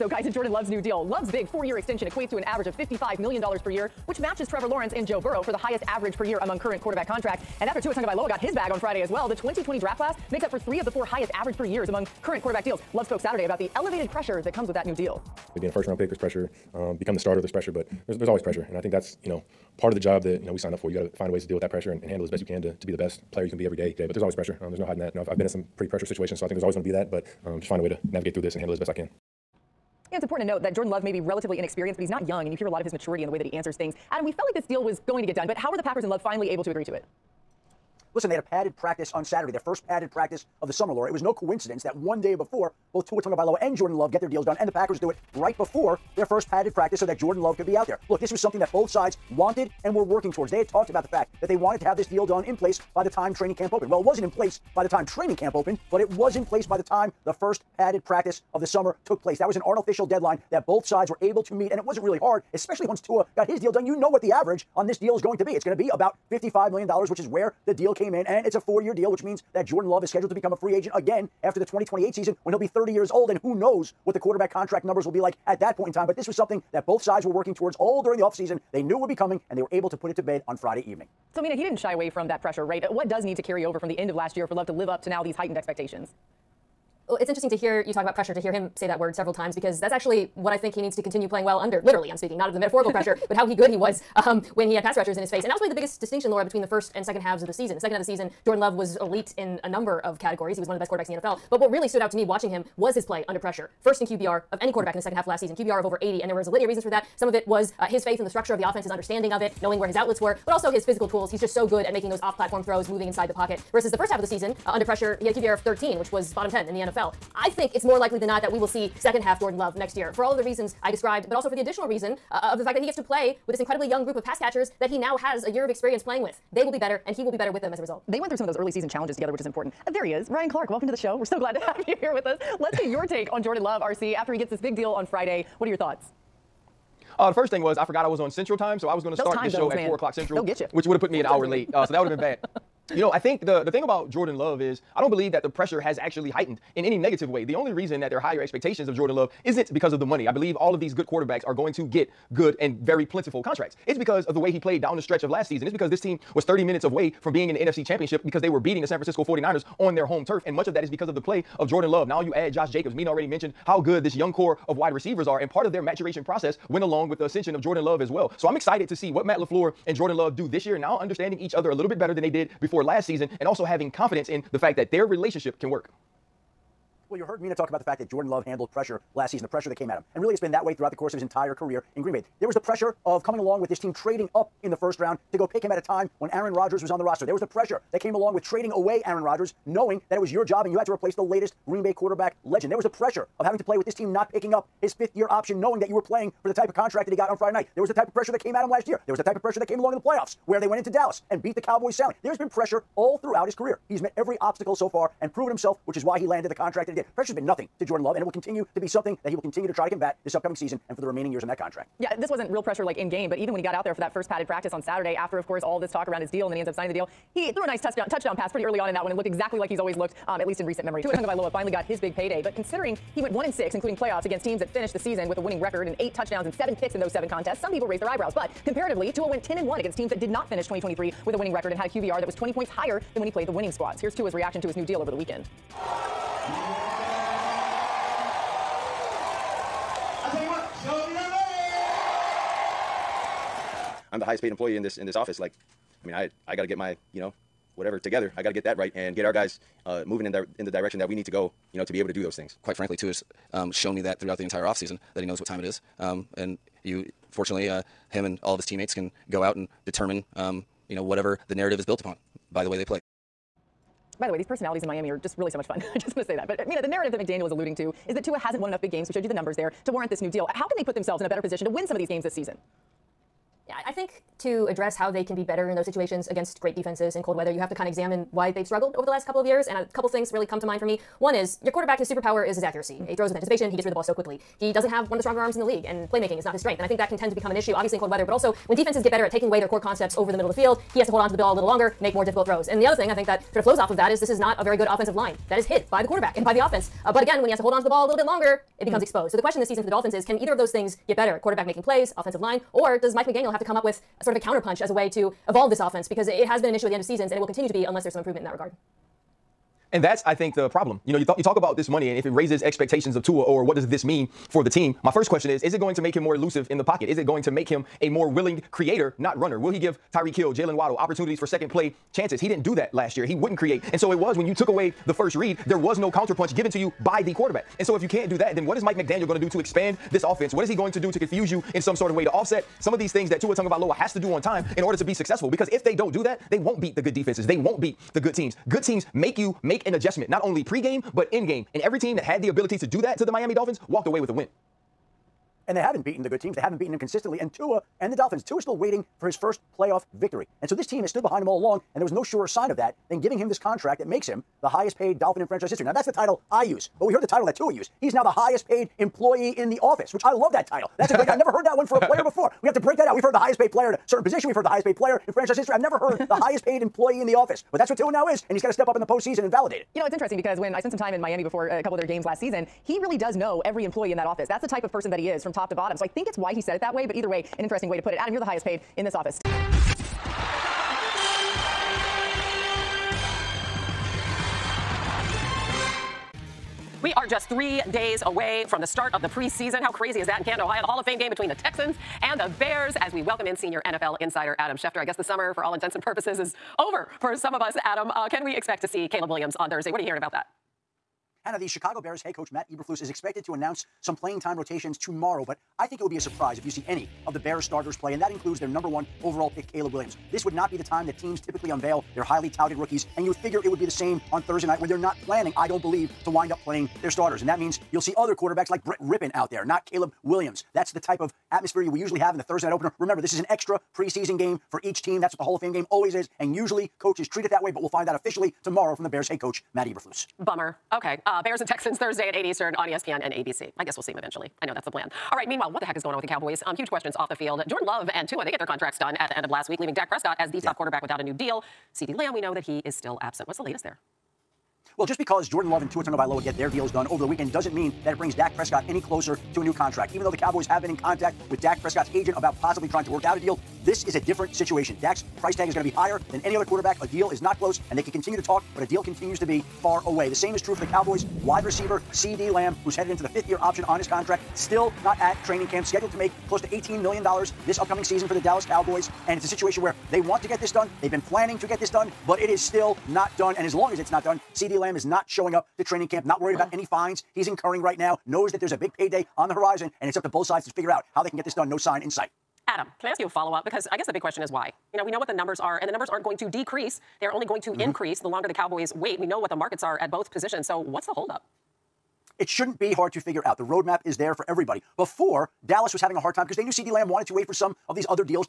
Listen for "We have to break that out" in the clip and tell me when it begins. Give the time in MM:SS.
06:02.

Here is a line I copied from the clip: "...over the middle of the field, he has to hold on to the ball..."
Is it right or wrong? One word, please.
right.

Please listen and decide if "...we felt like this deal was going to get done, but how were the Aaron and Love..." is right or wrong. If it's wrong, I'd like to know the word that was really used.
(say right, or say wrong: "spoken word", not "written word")
wrong: "Packers", not "Aaron".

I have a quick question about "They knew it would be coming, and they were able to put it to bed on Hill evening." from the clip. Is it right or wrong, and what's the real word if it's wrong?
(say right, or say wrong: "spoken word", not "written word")
wrong: "Friday", not "Hill".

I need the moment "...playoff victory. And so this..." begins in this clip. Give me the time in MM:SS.
05:49.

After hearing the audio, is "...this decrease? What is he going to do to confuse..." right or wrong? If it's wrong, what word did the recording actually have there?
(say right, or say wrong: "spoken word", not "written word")
wrong: "offense", not "decrease".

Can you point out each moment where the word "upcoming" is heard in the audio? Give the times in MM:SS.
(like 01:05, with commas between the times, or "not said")
03:30, 07:47.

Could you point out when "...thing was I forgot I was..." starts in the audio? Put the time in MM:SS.
02:17.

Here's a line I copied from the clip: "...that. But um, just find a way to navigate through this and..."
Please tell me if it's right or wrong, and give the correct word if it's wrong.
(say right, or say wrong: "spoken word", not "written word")
right.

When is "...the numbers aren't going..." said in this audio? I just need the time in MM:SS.
08:05.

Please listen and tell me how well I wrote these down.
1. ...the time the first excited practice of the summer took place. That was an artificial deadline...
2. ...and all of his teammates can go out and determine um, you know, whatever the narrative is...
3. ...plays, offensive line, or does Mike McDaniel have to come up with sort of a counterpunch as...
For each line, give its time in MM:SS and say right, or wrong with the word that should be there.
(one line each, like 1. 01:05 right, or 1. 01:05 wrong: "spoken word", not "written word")
1. 00:56 wrong: "padded", not "excited"
2. 04:18 right
3. 05:01 right.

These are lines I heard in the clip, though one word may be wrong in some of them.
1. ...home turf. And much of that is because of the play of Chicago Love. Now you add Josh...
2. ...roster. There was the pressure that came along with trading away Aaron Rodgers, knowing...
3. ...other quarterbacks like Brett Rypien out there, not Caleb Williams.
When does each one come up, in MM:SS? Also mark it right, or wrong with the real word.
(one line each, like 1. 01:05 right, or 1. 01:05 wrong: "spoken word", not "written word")
1. 02:40 wrong: "Jordan", not "Chicago"
2. 03:07 right
3. 06:58 right.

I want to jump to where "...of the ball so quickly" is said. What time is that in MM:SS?
04:43.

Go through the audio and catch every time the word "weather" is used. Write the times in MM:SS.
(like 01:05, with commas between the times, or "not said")
04:37, 04:48.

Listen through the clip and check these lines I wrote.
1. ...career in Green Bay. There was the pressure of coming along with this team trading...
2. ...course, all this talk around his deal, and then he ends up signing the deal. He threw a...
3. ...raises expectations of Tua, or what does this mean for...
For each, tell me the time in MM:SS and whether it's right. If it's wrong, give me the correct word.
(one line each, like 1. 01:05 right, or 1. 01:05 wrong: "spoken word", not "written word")
1. 03:01 right
2. 03:35 right
3. 05:12 right.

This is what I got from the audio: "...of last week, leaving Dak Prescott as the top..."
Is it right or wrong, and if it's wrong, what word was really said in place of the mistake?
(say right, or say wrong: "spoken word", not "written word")
right.